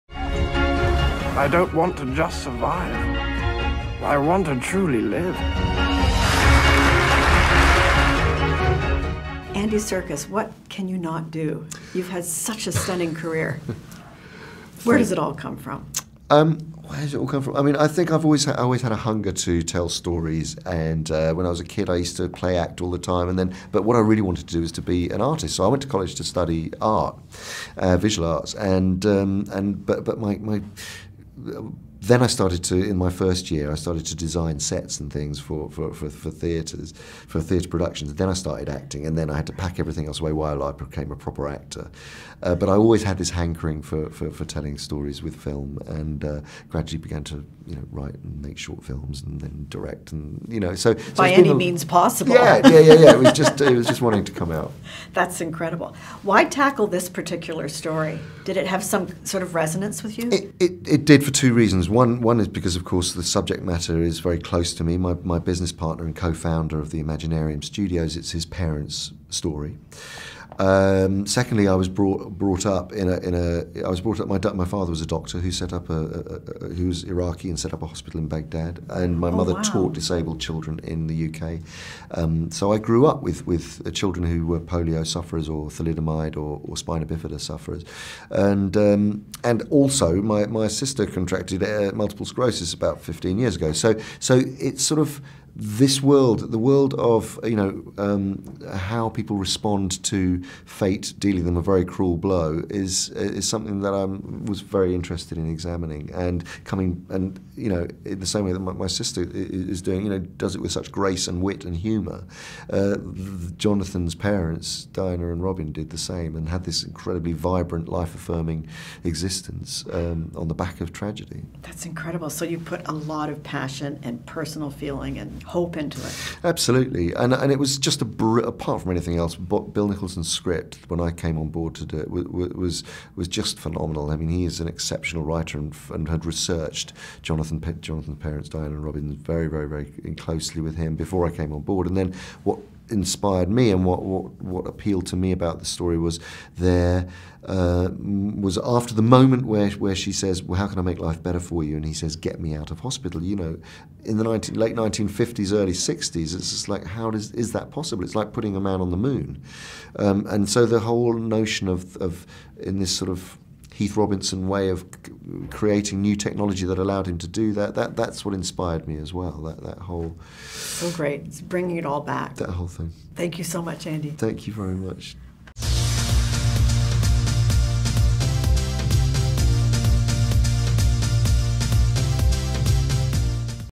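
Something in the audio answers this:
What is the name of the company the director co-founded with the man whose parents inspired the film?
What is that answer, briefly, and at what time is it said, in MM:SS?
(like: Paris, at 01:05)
Imaginarium Studios, at 01:07.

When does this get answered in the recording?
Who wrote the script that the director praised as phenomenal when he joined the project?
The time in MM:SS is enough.
02:09.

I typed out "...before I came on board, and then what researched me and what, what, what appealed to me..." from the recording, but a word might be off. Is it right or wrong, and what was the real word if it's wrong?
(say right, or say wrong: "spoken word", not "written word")
wrong: "inspired", not "researched".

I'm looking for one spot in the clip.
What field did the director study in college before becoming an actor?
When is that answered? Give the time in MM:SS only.
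00:27.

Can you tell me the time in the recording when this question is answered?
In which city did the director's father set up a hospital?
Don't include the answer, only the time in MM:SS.
01:18.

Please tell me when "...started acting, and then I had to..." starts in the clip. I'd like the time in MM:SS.
00:38.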